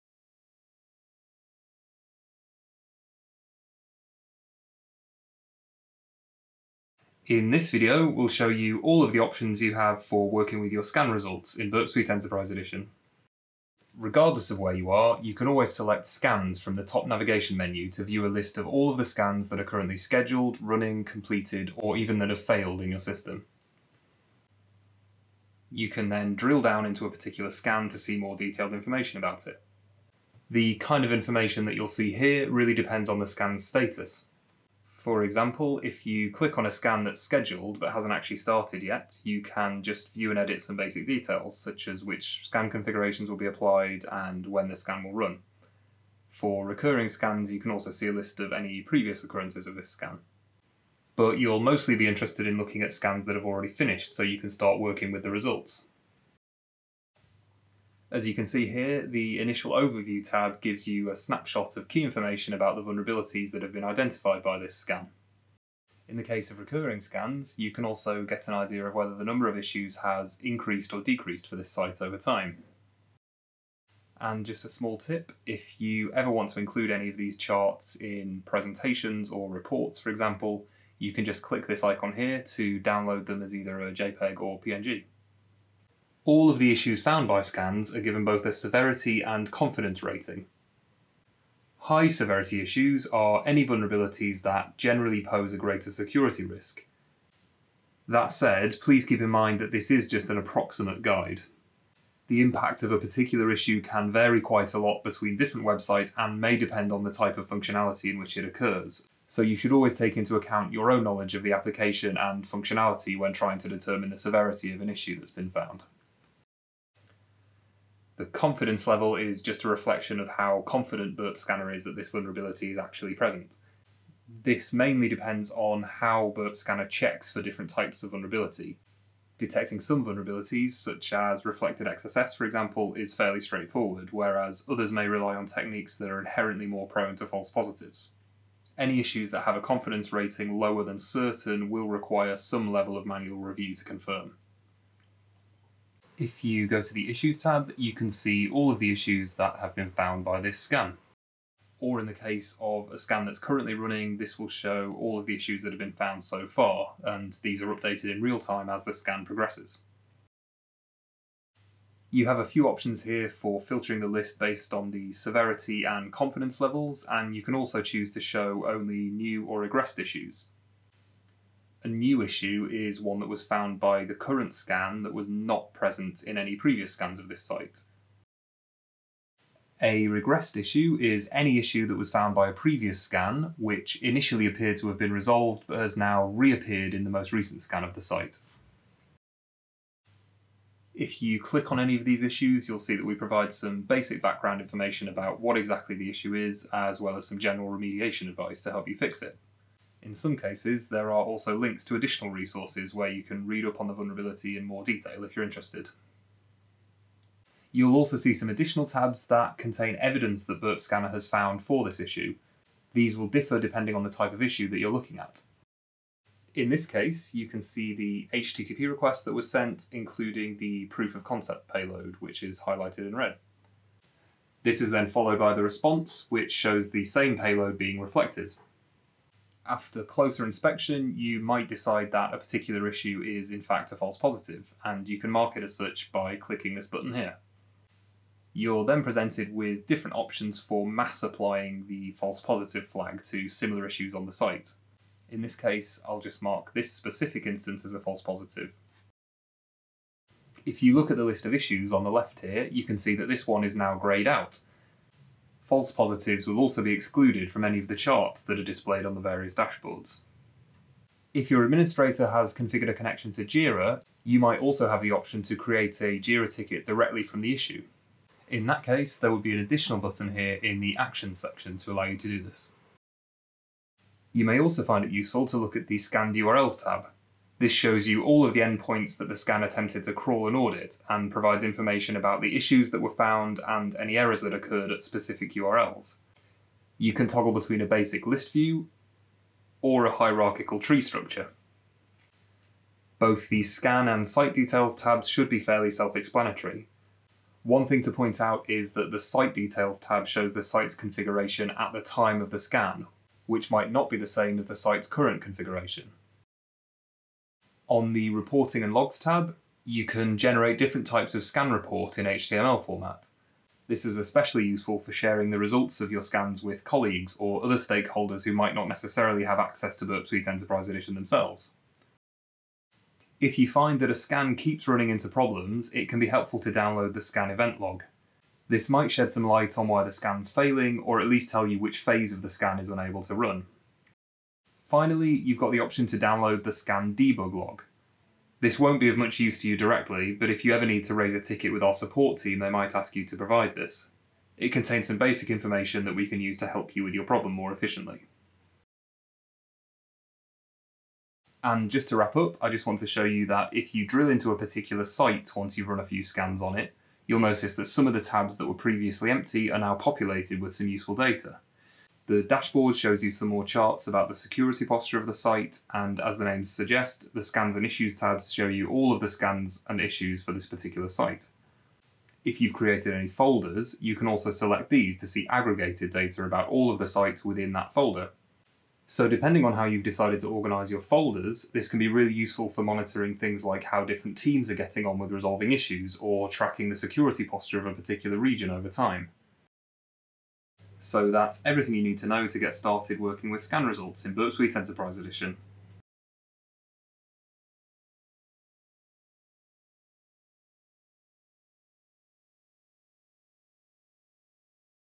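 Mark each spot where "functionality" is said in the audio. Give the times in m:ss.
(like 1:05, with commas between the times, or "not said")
1:47, 1:52.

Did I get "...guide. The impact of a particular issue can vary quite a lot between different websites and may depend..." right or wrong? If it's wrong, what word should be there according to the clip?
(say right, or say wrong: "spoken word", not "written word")
right.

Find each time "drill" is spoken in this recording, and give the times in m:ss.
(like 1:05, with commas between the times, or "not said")
0:26, 5:54.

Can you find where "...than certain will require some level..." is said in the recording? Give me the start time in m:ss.
2:20.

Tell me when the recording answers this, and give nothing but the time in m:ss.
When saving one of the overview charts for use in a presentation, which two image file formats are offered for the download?
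1:23.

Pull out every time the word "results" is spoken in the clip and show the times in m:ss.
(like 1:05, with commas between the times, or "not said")
0:11, 0:55, 5:15, 6:33.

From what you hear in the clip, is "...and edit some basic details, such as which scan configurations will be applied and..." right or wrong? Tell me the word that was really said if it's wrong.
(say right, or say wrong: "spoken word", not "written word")
right.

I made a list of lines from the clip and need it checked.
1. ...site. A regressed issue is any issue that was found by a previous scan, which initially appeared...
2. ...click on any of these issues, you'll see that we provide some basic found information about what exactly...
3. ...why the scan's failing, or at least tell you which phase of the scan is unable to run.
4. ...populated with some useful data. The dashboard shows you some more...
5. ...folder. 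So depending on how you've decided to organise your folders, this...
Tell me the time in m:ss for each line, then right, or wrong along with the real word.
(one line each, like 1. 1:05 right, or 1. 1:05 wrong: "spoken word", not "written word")
1. 2:57 right
2. 3:11 wrong: "background", not "found"
3. 5:29 right
4. 5:59 right
5. 6:17 right.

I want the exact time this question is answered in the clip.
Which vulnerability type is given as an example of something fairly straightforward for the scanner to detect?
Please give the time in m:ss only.
2:11.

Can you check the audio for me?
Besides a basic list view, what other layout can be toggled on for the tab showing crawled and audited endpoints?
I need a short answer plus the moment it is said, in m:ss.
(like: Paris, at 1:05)
hierarchical tree structure, at 4:50.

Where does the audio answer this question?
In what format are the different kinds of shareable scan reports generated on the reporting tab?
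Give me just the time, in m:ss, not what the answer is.
5:12.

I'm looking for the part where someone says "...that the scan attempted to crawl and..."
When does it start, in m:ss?
4:39.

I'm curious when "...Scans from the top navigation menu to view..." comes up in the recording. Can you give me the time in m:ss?
0:16.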